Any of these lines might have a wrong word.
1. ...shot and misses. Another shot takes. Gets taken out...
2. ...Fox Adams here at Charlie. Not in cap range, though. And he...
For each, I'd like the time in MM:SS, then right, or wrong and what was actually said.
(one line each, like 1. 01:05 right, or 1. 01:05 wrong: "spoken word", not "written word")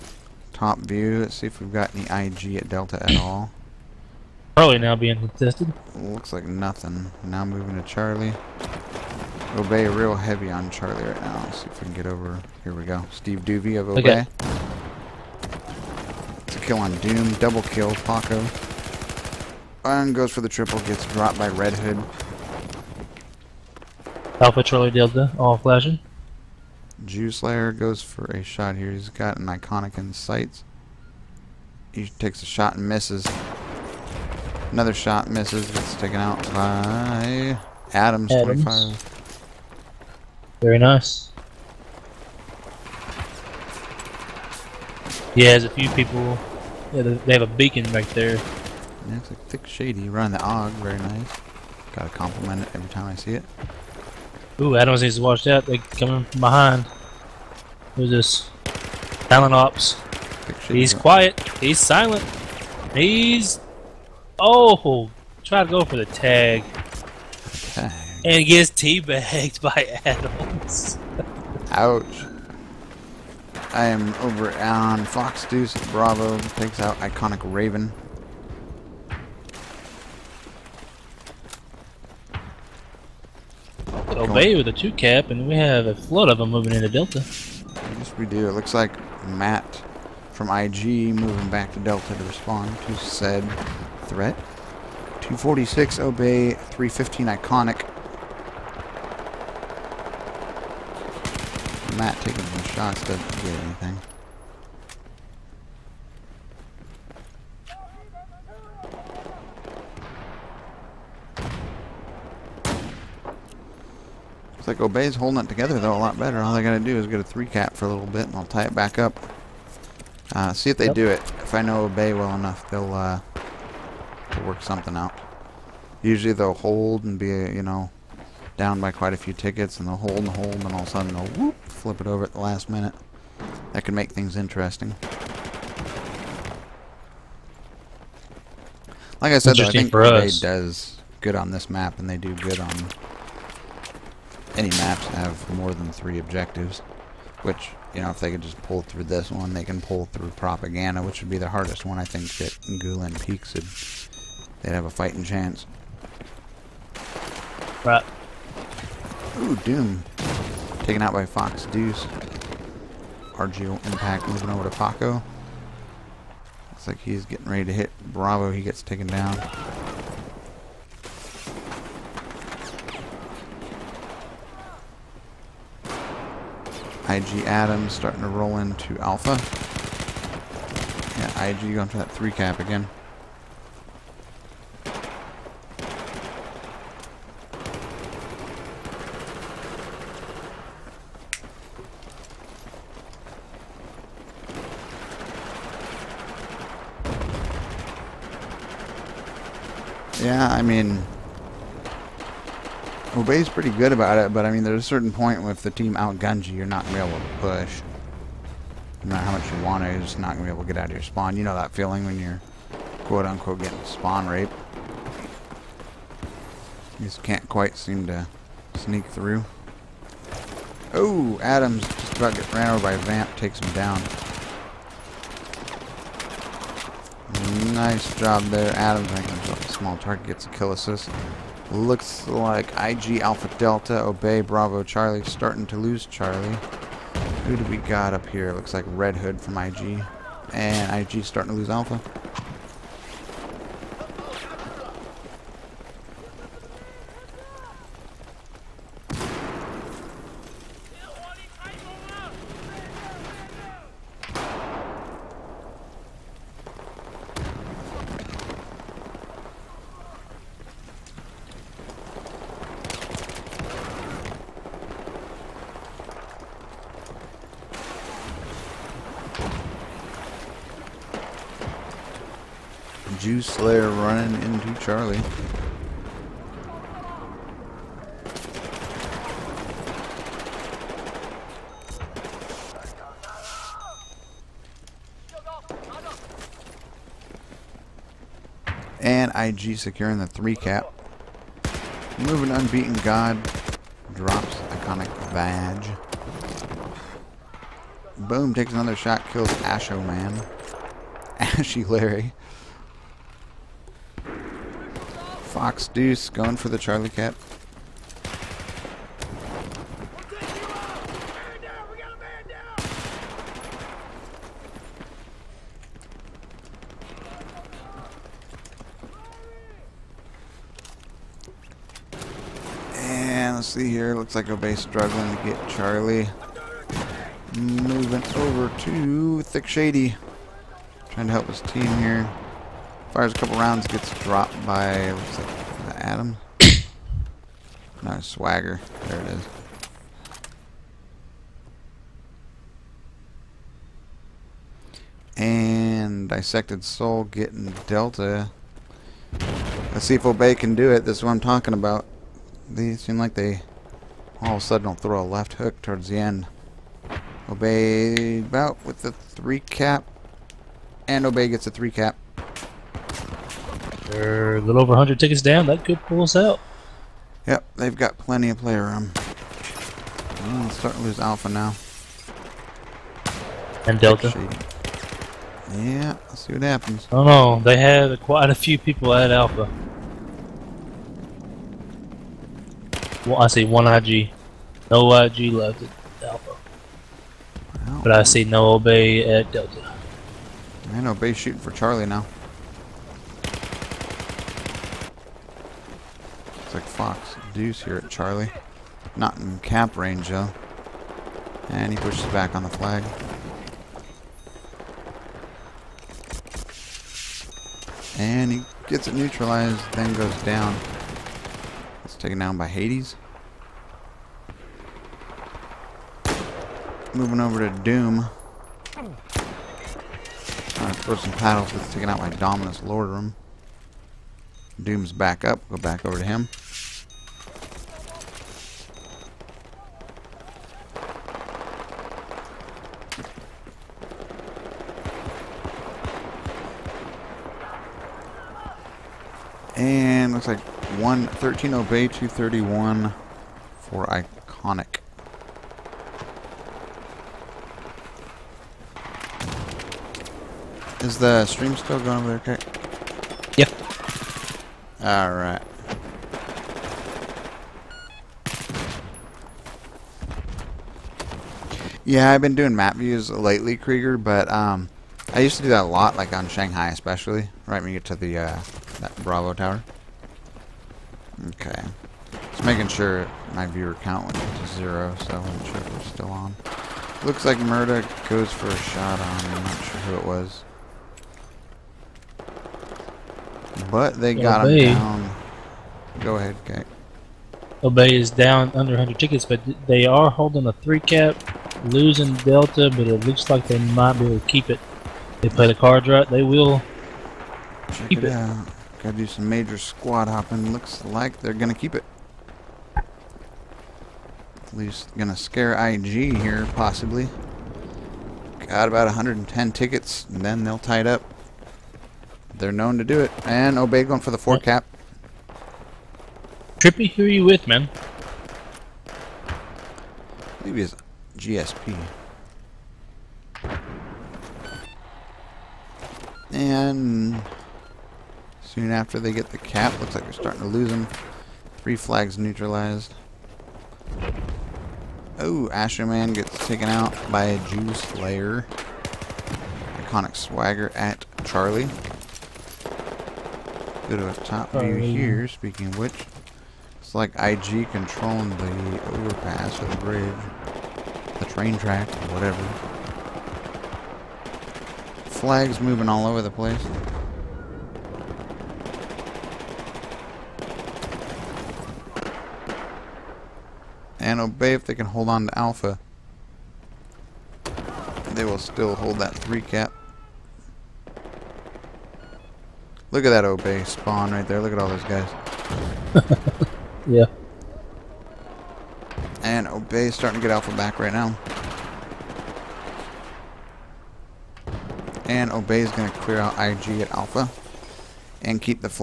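1. 00:32 wrong: "misses", not "takes"
2. 06:36 wrong: "Deuce", not "Adams".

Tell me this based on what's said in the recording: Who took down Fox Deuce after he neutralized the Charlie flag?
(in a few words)
Hades.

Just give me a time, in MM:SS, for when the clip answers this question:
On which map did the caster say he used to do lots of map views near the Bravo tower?
07:46.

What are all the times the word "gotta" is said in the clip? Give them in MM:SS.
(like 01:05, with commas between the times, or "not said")
00:51, 01:56, 08:19.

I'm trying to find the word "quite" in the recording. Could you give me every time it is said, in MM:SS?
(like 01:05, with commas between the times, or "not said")
02:08, 03:37, 06:18.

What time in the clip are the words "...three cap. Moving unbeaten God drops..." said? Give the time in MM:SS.
04:50.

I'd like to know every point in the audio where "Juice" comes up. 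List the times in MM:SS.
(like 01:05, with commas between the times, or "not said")
00:27, 08:57.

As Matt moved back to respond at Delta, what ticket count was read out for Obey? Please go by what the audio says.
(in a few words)
246.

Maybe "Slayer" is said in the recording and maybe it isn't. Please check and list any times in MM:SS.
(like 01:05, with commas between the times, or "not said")
00:27, 08:57.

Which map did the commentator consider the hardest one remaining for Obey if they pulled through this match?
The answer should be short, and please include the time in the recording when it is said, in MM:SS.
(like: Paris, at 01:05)
Propaganda, at 02:30.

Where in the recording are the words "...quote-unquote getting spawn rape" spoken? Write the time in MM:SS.
03:33.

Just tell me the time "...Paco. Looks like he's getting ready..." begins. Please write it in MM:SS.
02:44.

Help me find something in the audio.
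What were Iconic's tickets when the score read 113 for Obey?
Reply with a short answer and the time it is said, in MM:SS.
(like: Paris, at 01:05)
231, at 07:22.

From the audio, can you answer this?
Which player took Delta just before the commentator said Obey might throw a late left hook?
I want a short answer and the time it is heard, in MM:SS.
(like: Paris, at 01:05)
Dissected Soul, at 05:46.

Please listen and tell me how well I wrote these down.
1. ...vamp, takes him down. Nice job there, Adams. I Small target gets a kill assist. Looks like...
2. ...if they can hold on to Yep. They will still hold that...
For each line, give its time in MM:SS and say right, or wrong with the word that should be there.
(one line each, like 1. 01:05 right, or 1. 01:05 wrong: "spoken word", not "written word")
1. 03:42 right
2. 09:24 wrong: "Alpha", not "Yep".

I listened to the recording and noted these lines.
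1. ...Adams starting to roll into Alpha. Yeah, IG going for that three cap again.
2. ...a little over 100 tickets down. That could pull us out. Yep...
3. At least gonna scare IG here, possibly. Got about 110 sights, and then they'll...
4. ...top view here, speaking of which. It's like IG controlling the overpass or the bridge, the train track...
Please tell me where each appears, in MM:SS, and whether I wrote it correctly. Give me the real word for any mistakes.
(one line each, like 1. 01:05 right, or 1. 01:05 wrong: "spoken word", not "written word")
1. 02:57 right
2. 06:04 right
3. 08:22 wrong: "tickets", not "sights"
4. 09:04 right.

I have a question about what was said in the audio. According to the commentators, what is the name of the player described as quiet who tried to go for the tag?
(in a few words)
Silent Ops.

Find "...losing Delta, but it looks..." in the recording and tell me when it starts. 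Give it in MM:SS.
08:11.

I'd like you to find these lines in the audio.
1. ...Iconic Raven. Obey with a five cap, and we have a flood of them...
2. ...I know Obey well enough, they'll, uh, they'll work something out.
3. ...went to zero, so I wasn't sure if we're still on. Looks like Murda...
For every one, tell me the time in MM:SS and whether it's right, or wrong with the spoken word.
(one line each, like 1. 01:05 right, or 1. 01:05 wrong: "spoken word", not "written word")
1. 01:16 wrong: "two", not "five"
2. 02:01 right
3. 07:54 right.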